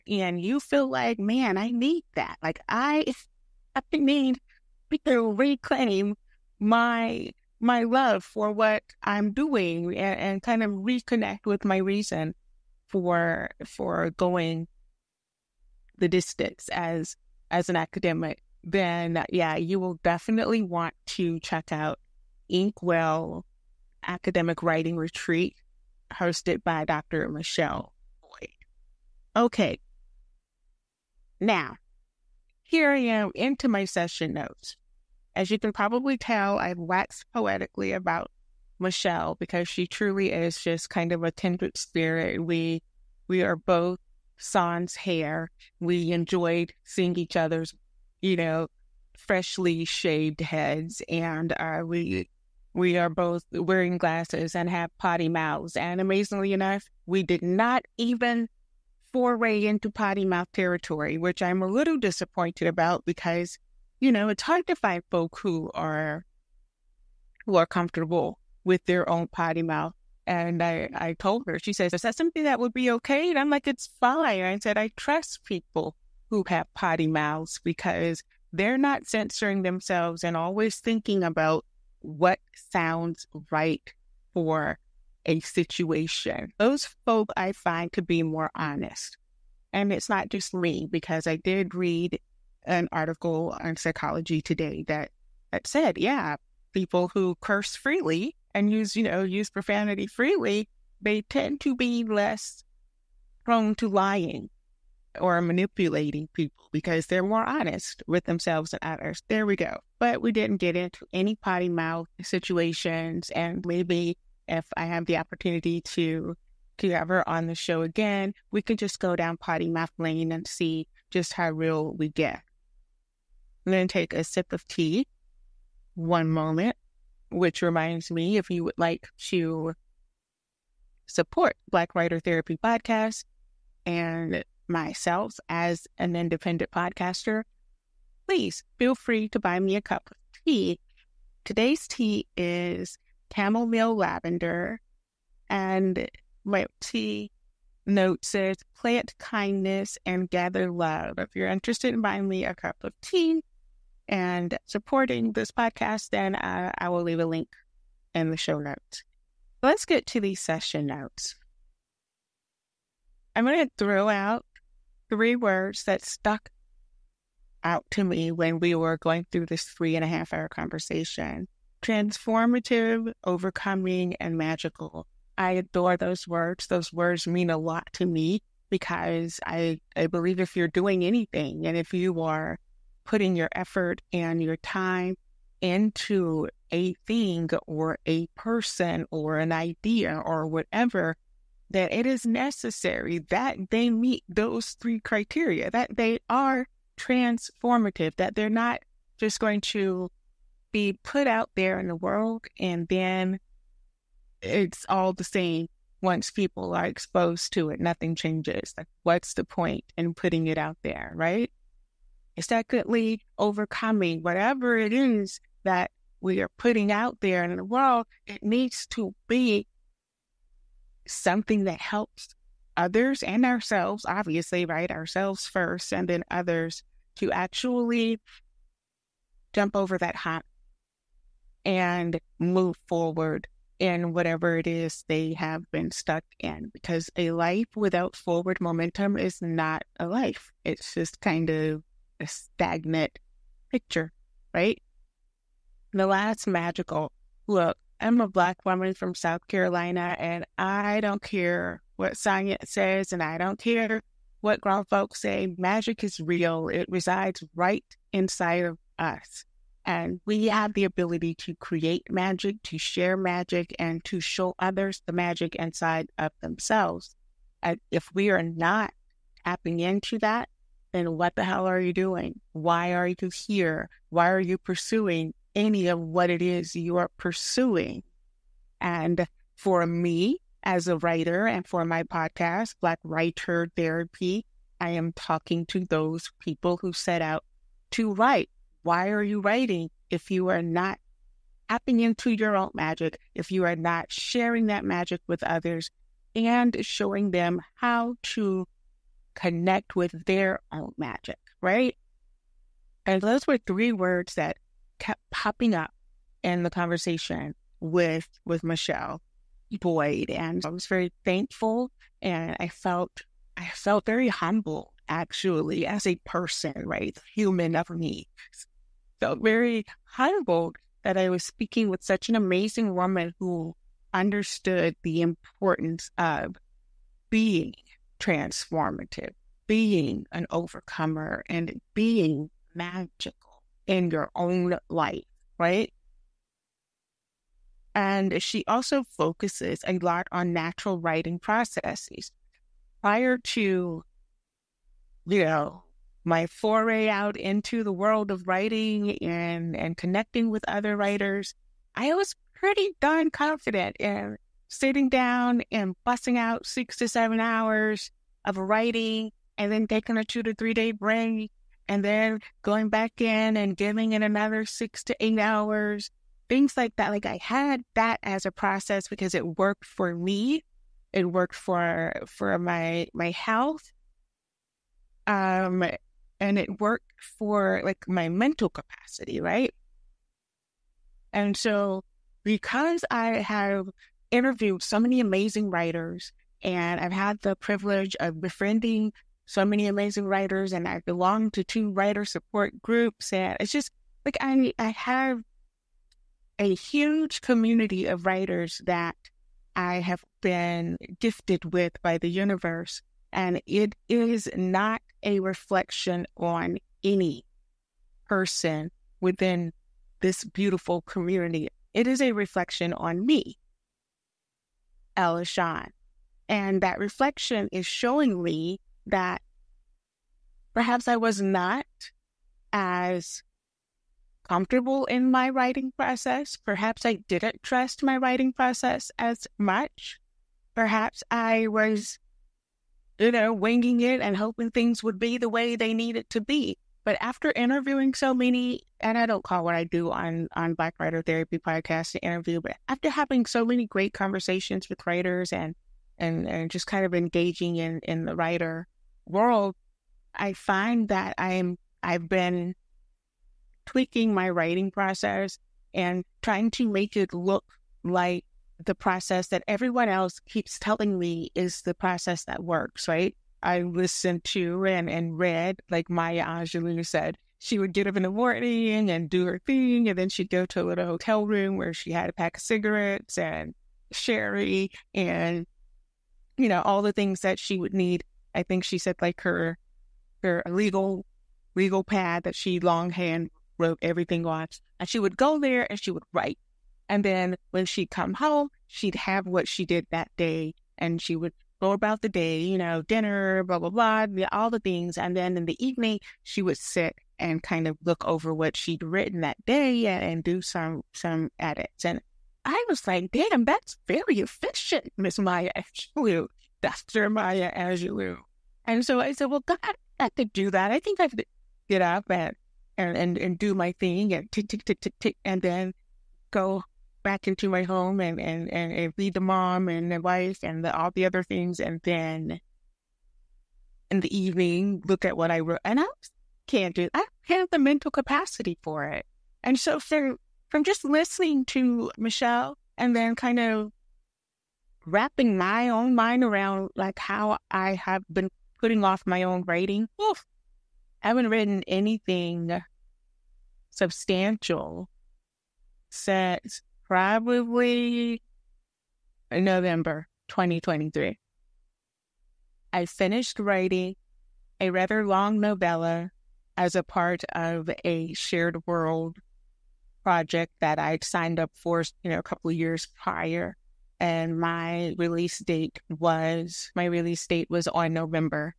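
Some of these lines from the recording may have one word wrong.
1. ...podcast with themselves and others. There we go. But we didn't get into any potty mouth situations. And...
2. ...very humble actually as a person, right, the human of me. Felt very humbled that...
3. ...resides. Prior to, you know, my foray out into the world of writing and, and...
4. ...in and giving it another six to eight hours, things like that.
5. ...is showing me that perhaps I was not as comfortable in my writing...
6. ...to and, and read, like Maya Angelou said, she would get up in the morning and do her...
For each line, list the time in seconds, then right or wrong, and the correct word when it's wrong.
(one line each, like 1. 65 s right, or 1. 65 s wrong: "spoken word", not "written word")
1. 107 s wrong: "honest", not "podcast"
2. 314 s right
3. 341 s wrong: "processes", not "resides"
4. 363 s right
5. 417 s right
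6. 464 s right.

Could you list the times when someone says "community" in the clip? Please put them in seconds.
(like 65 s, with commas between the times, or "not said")
397 s, 411 s.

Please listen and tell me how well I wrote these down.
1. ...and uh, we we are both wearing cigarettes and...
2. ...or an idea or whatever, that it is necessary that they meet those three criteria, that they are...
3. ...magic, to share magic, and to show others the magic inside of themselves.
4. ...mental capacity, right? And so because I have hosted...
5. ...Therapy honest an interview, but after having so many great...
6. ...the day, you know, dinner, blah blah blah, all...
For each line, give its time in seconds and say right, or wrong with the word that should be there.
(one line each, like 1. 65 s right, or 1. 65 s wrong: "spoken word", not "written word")
1. 51 s wrong: "glasses", not "cigarettes"
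2. 189 s right
3. 262 s right
4. 378 s wrong: "interviewed", not "hosted"
5. 441 s wrong: "podcast", not "honest"
6. 492 s right.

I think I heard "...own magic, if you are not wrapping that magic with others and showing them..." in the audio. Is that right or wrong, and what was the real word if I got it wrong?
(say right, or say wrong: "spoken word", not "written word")
wrong: "sharing", not "wrapping".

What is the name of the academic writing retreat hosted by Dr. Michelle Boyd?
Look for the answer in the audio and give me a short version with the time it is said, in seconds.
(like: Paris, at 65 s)
Inkwell Academic Writing Retreat, at 22 s.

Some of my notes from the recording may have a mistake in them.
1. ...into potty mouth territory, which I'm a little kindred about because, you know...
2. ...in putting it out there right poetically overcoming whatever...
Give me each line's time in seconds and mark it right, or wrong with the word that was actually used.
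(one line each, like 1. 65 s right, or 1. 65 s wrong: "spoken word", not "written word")
1. 59 s wrong: "disappointed", not "kindred"
2. 209 s wrong: "secondly", not "poetically".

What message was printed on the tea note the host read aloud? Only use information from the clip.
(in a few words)
Plant kindness and gather love.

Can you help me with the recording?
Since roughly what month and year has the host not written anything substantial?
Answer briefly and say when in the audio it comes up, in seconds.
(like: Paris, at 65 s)
November 2023, at 549 s.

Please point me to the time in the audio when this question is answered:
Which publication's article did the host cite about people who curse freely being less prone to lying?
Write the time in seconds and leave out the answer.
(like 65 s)
93 s.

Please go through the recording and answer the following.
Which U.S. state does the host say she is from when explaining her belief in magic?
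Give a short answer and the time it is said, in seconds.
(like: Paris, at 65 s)
South Carolina, at 249 s.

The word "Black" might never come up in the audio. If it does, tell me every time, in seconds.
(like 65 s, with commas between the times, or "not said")
131 s, 248 s, 282 s, 440 s.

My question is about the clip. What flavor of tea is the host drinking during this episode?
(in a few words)
Chamomile lavender.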